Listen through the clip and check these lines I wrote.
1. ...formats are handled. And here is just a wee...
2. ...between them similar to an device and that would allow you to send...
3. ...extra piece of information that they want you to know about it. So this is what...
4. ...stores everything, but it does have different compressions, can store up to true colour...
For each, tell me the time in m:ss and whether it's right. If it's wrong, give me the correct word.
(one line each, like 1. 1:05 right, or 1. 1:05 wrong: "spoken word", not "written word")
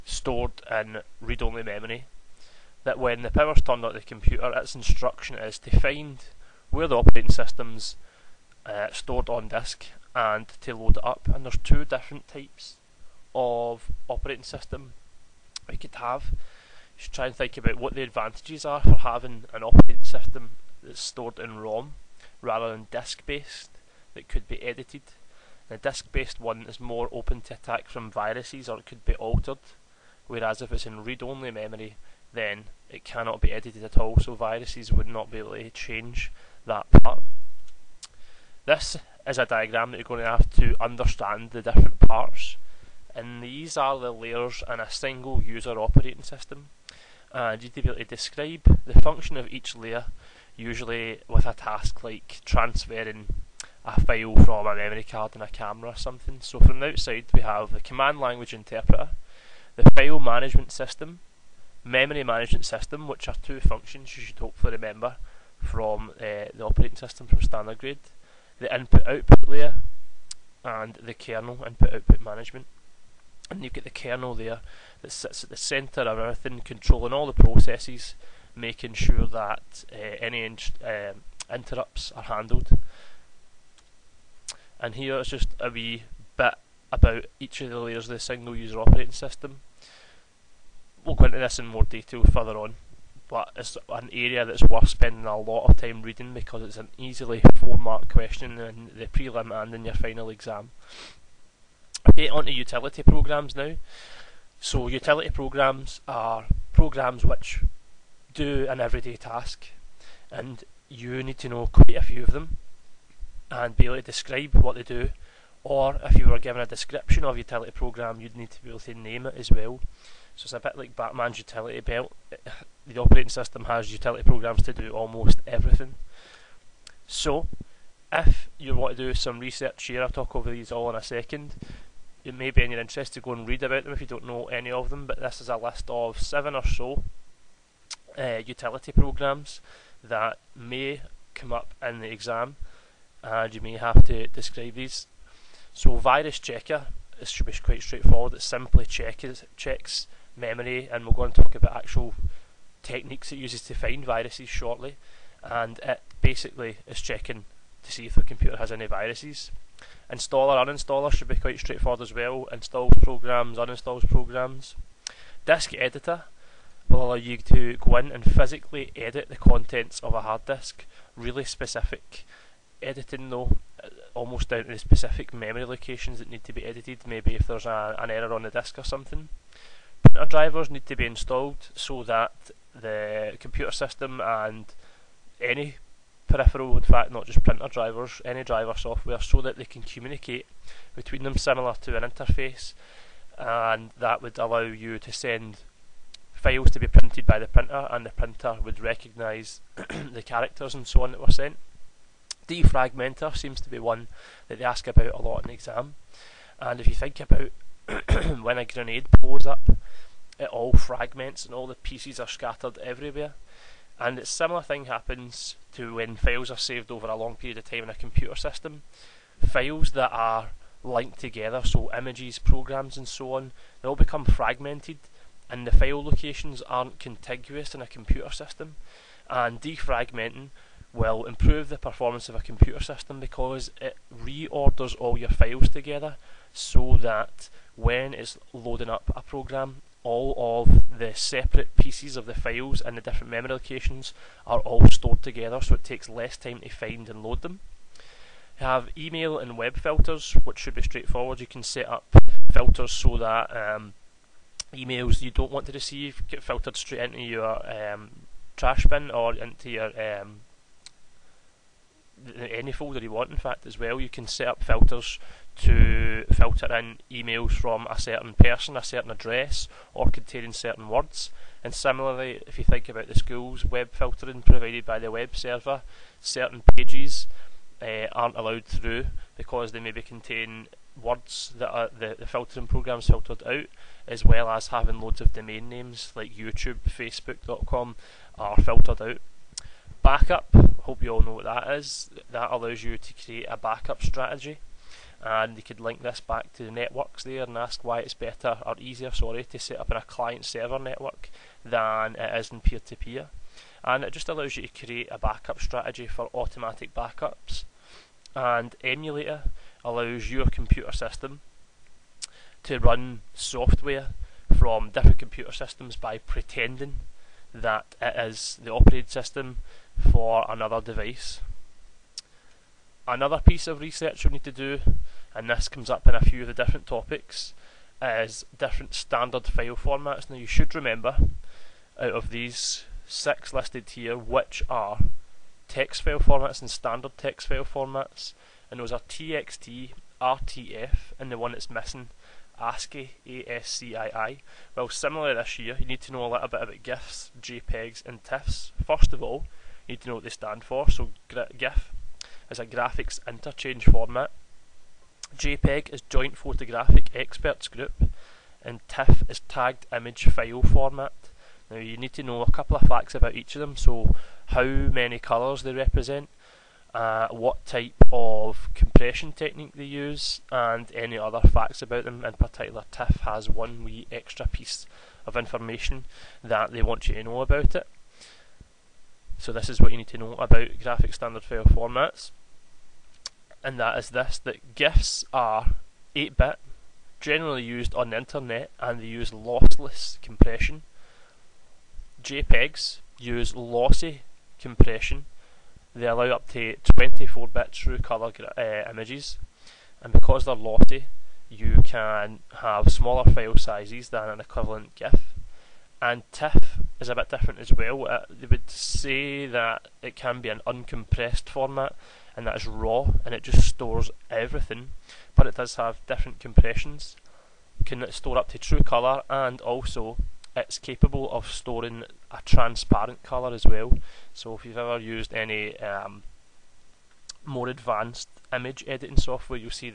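1. 1:21 wrong: "interrupts", not "formats"
2. 3:10 wrong: "interface", not "device"
3. 6:14 right
4. 6:53 right.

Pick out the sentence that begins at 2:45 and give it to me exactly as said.
Disk editor will allow you to go in and physically edit the contents of a hard disk.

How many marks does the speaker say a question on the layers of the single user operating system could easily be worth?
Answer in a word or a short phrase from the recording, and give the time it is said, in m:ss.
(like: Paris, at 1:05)
4, at 1:37.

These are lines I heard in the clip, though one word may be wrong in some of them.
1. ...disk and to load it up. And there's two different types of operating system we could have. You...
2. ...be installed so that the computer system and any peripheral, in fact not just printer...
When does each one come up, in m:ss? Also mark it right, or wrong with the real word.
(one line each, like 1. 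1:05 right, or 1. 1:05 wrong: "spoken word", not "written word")
1. 0:09 right
2. 3:00 right.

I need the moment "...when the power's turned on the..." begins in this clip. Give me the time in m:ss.
0:02.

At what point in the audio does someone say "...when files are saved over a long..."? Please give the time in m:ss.
3:35.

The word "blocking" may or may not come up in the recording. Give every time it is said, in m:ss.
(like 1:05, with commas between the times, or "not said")
not said.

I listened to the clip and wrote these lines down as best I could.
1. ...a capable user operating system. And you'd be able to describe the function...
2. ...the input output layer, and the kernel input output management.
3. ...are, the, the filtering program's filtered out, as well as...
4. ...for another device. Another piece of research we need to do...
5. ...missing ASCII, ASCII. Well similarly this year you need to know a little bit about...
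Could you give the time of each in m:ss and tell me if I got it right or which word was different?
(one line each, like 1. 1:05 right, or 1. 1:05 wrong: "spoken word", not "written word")
1. 0:44 wrong: "single", not "capable"
2. 1:08 right
3. 4:41 right
4. 5:19 right
5. 5:41 right.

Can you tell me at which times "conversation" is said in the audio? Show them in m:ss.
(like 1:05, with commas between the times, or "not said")
not said.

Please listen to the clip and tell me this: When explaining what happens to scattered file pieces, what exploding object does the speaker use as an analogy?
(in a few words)
a grenade.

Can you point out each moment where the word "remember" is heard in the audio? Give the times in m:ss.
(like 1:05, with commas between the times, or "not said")
1:04, 5:30.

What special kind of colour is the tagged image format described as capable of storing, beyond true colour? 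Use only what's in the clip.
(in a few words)
a transparent colour.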